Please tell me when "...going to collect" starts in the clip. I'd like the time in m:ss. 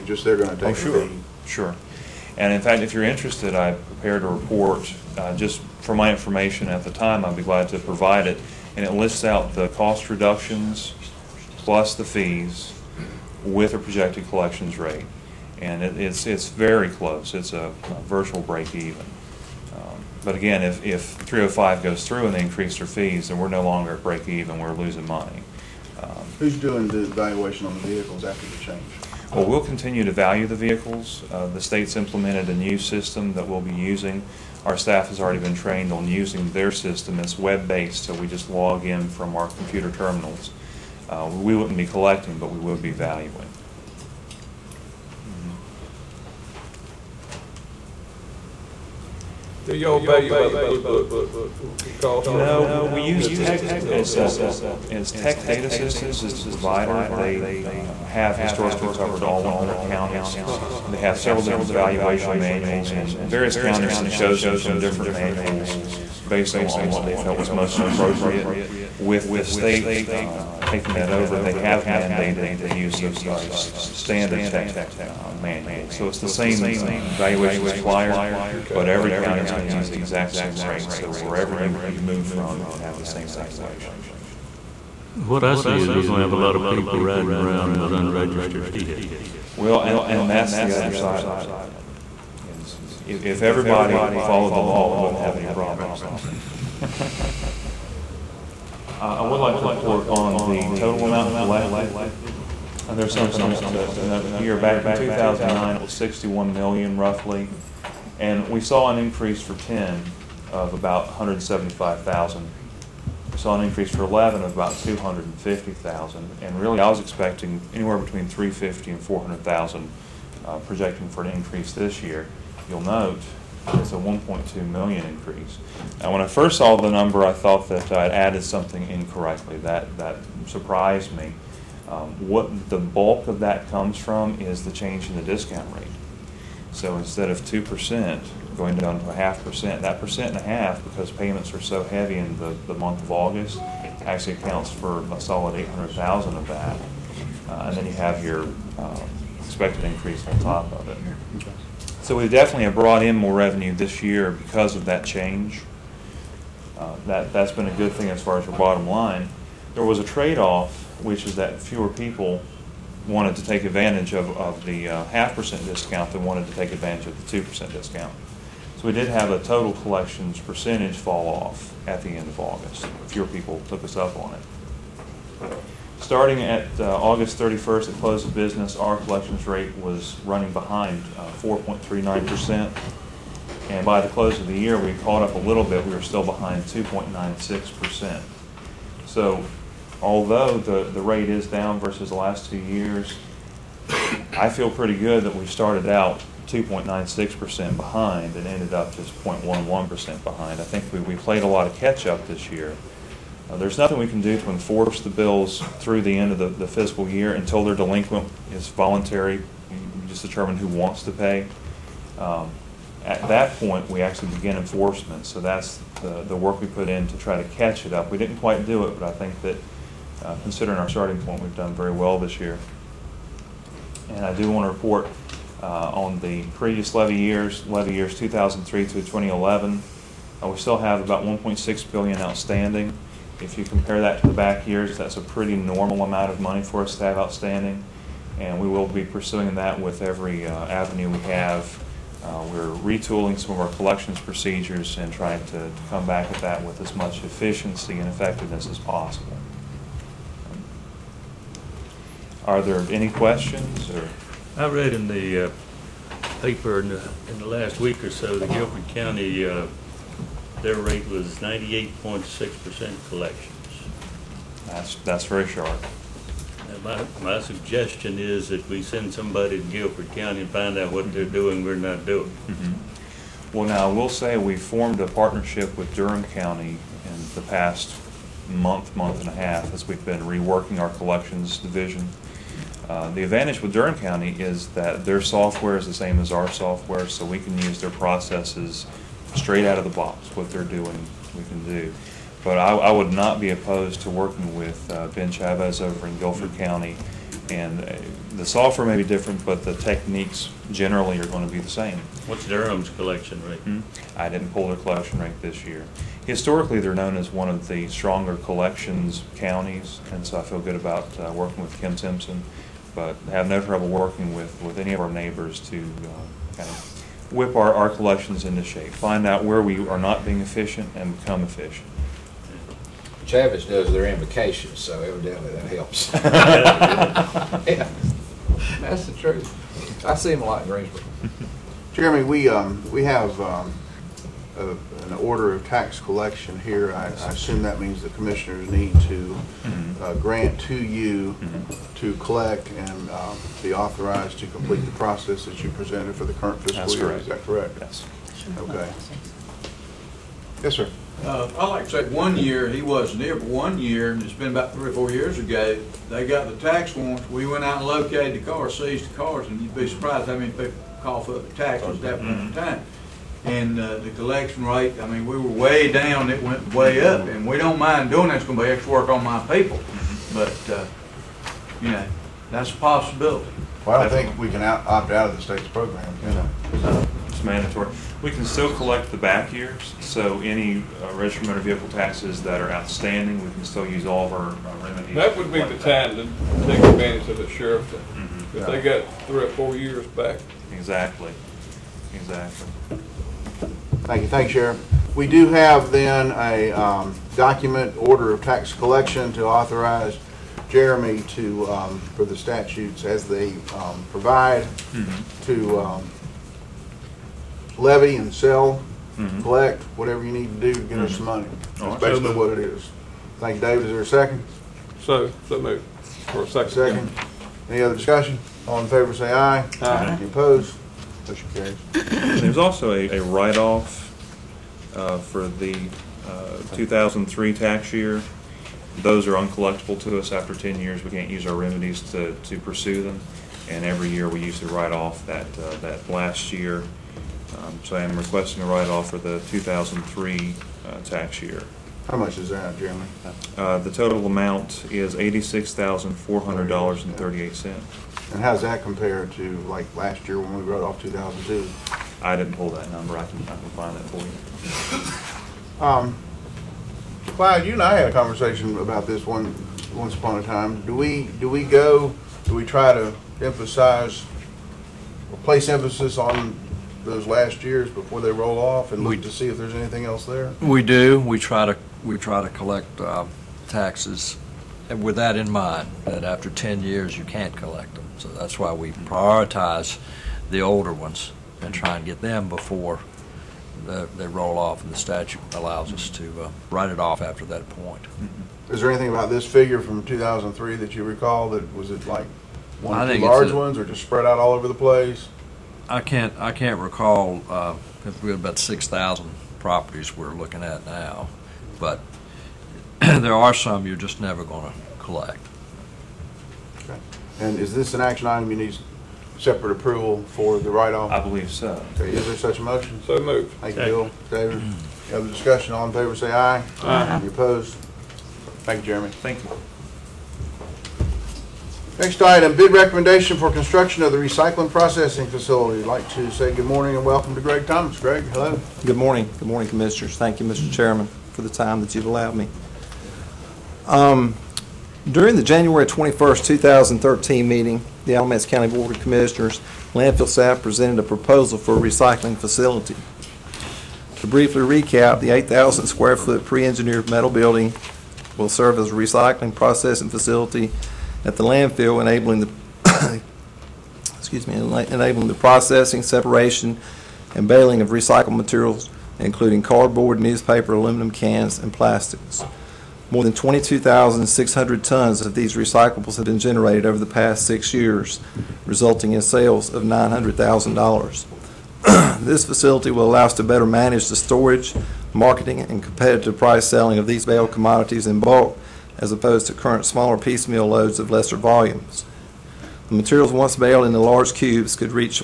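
8:24.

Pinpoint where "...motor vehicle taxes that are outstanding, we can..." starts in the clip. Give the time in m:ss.
6:21.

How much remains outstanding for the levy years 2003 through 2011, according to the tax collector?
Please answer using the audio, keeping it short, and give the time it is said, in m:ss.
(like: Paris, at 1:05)
1.6 billion, at 3:51.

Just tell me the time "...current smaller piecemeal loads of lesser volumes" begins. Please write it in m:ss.
9:39.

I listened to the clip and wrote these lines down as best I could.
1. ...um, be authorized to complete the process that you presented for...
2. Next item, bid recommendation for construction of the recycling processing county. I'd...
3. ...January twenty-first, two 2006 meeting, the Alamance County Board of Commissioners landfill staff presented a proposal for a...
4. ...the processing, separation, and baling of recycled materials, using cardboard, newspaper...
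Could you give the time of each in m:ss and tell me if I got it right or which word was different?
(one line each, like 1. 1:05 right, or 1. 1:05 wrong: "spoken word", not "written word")
1. 5:43 right
2. 8:41 wrong: "facility", not "county"
3. 8:55 wrong: "2013", not "2006"
4. 9:15 wrong: "including", not "using".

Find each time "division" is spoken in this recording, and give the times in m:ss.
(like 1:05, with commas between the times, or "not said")
4:41.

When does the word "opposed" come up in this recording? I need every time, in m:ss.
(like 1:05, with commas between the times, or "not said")
4:53, 7:00, 8:37, 9:39.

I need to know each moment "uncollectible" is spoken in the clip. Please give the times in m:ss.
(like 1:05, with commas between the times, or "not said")
7:09.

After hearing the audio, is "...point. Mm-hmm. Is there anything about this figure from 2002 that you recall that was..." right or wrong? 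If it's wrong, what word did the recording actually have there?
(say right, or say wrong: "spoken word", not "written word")
wrong: "2003", not "2002".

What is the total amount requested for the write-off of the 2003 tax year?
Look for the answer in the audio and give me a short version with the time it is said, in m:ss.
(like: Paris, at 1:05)
$86,400.38, at 7:25.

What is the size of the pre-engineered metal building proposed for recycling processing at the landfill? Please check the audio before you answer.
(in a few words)
8,000 square feet.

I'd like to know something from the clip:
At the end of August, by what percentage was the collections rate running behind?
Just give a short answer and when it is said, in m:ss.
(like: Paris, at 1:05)
4.39%, at 3:01.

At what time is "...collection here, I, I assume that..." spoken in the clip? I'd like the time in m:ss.
5:35.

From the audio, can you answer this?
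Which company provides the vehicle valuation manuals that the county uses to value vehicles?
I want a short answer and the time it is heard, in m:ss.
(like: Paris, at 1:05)
Tech Data Systems, at 0:55.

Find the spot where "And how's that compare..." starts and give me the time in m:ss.
7:28.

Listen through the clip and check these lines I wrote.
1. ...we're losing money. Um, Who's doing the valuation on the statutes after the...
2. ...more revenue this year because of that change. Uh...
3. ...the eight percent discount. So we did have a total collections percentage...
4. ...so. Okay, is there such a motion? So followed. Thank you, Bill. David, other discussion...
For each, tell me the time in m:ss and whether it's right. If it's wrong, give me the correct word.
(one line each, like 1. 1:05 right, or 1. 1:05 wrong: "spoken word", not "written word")
1. 0:24 wrong: "vehicles", not "statutes"
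2. 2:33 right
3. 2:47 wrong: "two", not "eight"
4. 8:31 wrong: "moved", not "followed".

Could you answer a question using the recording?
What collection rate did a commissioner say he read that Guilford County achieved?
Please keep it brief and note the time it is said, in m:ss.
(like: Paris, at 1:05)
98.6%, at 4:21.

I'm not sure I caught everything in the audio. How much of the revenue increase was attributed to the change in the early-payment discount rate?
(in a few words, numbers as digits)
800,000.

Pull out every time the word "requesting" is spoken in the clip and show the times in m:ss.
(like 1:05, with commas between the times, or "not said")
7:18.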